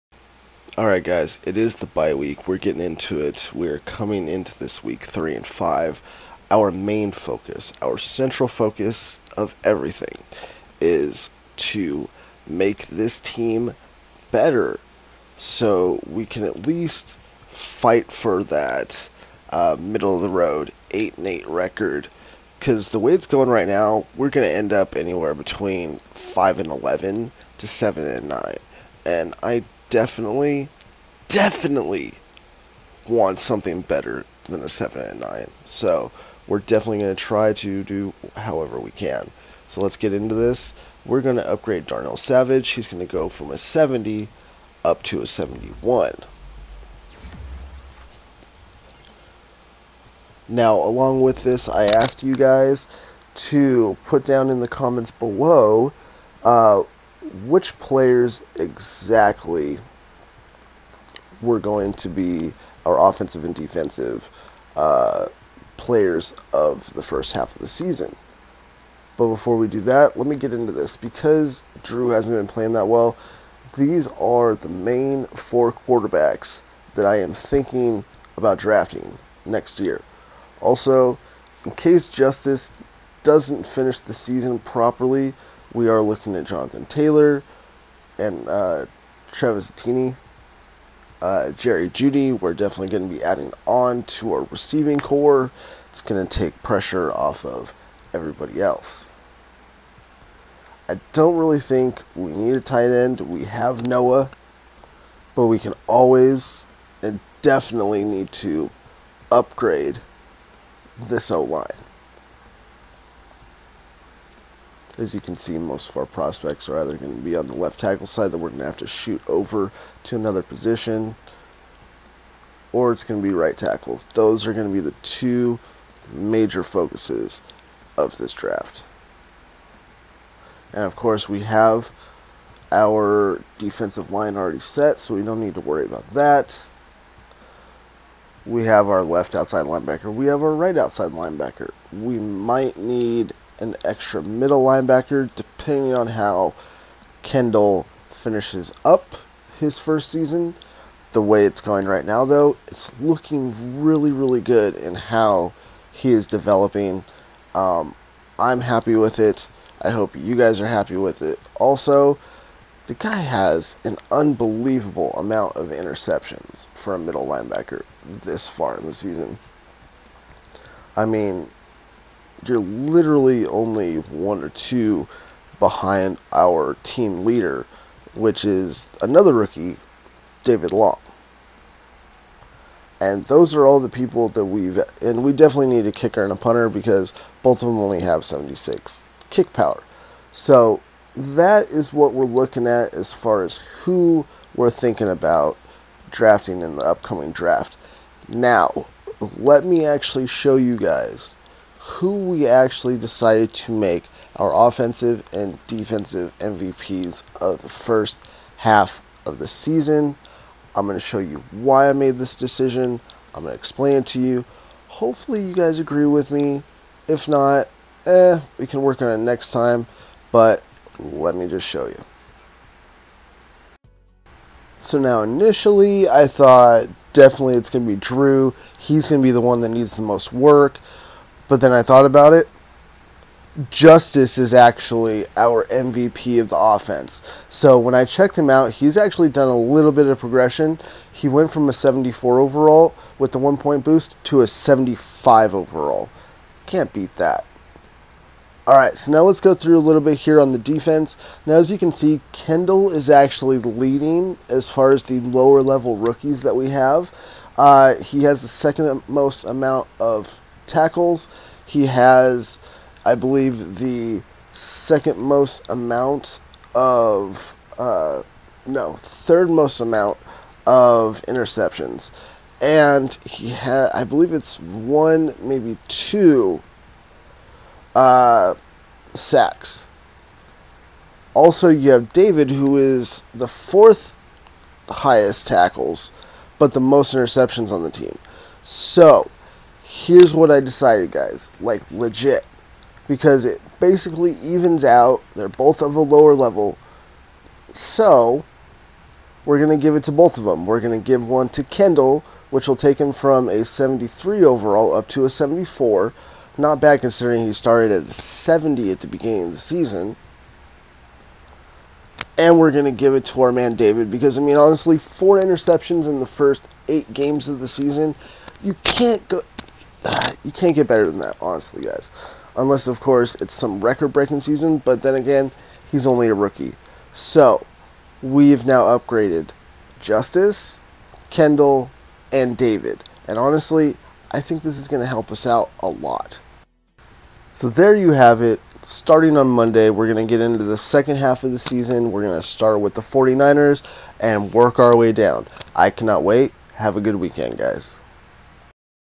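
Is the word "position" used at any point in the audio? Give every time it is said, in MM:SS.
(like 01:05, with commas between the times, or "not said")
02:00.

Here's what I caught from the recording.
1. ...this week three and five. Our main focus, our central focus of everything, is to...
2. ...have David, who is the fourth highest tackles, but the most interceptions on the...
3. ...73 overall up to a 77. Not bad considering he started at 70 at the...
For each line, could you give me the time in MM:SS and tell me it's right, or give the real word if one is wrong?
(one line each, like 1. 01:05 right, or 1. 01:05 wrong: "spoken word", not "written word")
1. 00:04 right
2. 04:41 right
3. 05:03 wrong: "74", not "77".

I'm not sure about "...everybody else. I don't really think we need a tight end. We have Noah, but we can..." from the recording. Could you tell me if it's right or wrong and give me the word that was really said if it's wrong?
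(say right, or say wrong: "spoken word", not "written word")
right.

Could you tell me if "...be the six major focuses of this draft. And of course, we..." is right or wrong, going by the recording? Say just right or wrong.
wrong.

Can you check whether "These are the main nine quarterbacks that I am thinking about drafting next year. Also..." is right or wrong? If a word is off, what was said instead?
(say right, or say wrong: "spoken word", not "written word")
wrong: "four", not "nine".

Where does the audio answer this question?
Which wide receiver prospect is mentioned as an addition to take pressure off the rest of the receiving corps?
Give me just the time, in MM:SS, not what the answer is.
01:31.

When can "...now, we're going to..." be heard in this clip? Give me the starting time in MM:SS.
00:23.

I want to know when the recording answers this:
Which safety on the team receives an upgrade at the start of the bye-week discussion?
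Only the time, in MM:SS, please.
00:41.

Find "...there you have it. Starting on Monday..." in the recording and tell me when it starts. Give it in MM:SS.
05:37.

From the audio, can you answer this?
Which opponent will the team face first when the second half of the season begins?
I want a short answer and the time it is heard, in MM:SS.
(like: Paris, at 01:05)
49ers, at 05:43.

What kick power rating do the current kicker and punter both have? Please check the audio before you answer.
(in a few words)
76.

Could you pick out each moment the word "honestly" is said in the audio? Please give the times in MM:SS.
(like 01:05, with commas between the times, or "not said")
05:14, 05:21, 05:33.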